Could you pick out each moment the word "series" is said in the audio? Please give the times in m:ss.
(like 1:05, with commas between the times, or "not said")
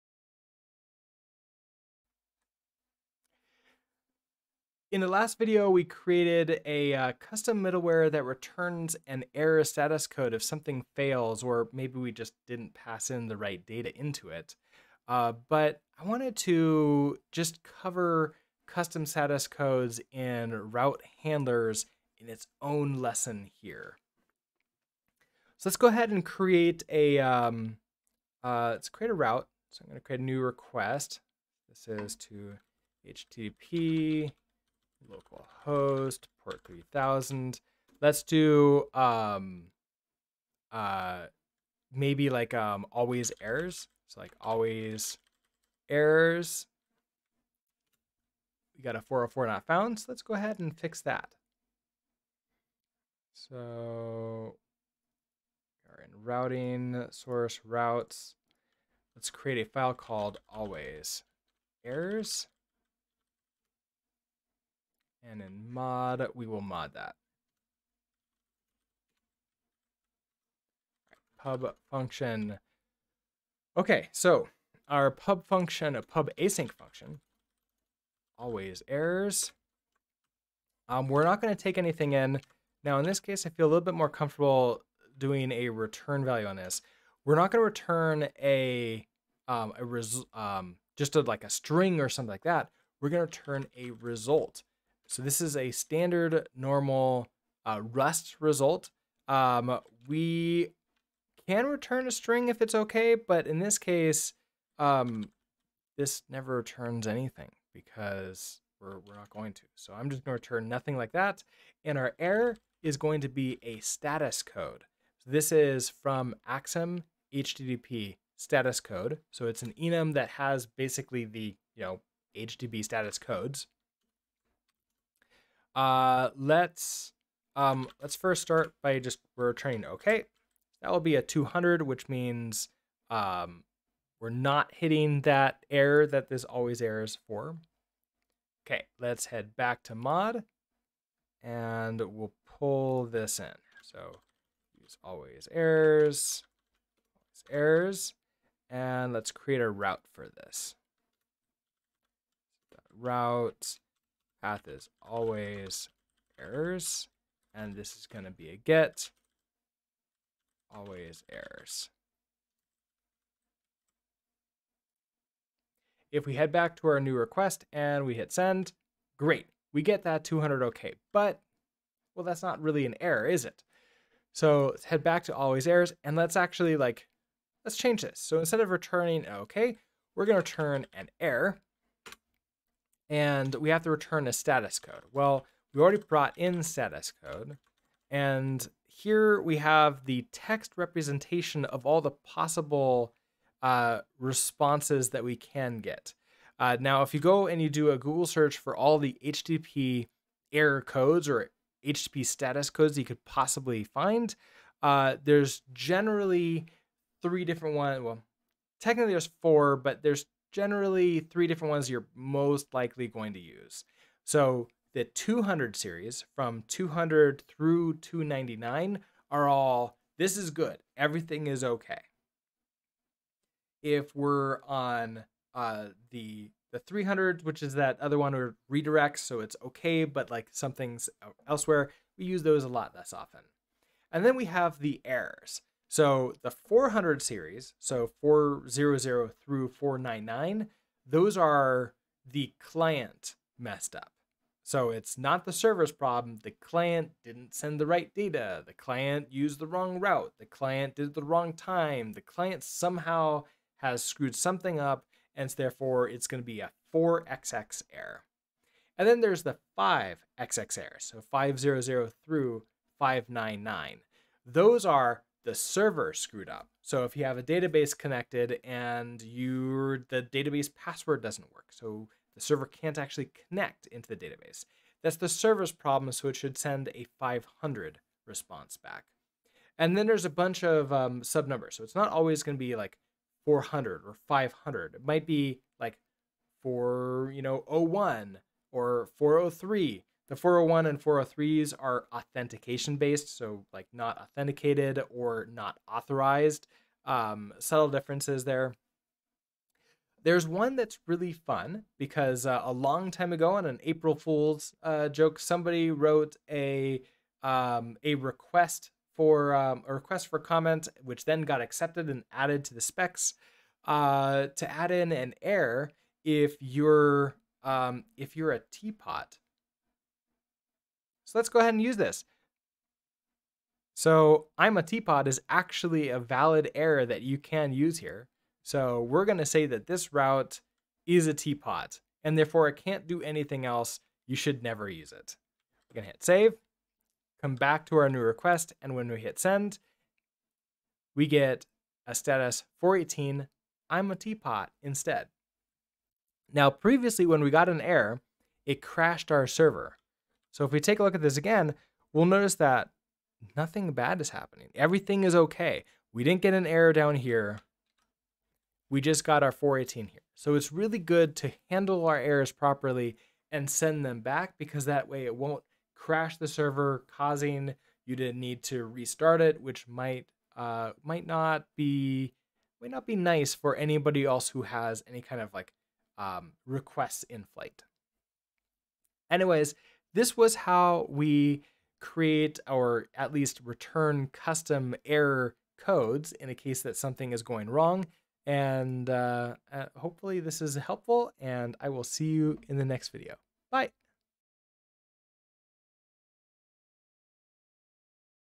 3:35, 3:57.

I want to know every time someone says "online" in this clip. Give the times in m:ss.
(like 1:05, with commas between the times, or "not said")
not said.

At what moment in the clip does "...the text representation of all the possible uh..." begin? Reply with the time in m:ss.
3:10.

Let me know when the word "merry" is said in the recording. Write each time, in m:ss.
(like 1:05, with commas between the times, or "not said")
not said.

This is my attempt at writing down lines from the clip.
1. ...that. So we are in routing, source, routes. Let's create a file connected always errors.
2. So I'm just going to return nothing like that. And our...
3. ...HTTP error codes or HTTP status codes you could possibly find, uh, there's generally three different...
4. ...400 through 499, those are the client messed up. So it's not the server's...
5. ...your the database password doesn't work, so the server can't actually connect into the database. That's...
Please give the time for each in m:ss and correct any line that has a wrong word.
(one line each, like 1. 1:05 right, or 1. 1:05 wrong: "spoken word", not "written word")
1. 0:51 wrong: "called", not "connected"
2. 1:49 right
3. 3:19 right
4. 3:58 right
5. 4:29 right.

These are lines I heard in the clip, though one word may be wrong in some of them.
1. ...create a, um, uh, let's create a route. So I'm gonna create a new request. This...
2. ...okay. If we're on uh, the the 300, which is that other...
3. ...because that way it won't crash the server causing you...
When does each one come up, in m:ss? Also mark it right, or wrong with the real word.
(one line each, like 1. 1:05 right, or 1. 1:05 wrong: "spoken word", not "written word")
1. 0:26 right
2. 3:41 right
3. 6:04 right.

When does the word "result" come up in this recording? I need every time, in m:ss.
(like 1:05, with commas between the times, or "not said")
1:33, 1:38.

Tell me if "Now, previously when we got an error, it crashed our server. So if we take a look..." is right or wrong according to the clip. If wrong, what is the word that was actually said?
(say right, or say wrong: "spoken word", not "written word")
right.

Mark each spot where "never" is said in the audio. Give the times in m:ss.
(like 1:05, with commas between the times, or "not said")
1:46, 5:34.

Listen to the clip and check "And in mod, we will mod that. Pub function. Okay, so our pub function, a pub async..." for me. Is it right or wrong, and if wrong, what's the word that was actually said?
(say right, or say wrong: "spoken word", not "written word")
right.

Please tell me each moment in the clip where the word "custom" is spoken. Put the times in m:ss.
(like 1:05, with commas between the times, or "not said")
0:07, 0:18, 6:24.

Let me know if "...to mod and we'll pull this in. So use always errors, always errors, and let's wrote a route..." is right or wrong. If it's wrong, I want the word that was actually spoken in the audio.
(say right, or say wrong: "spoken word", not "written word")
wrong: "create", not "wrote".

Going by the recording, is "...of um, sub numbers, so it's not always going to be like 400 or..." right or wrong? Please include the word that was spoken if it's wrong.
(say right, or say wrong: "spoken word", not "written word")
right.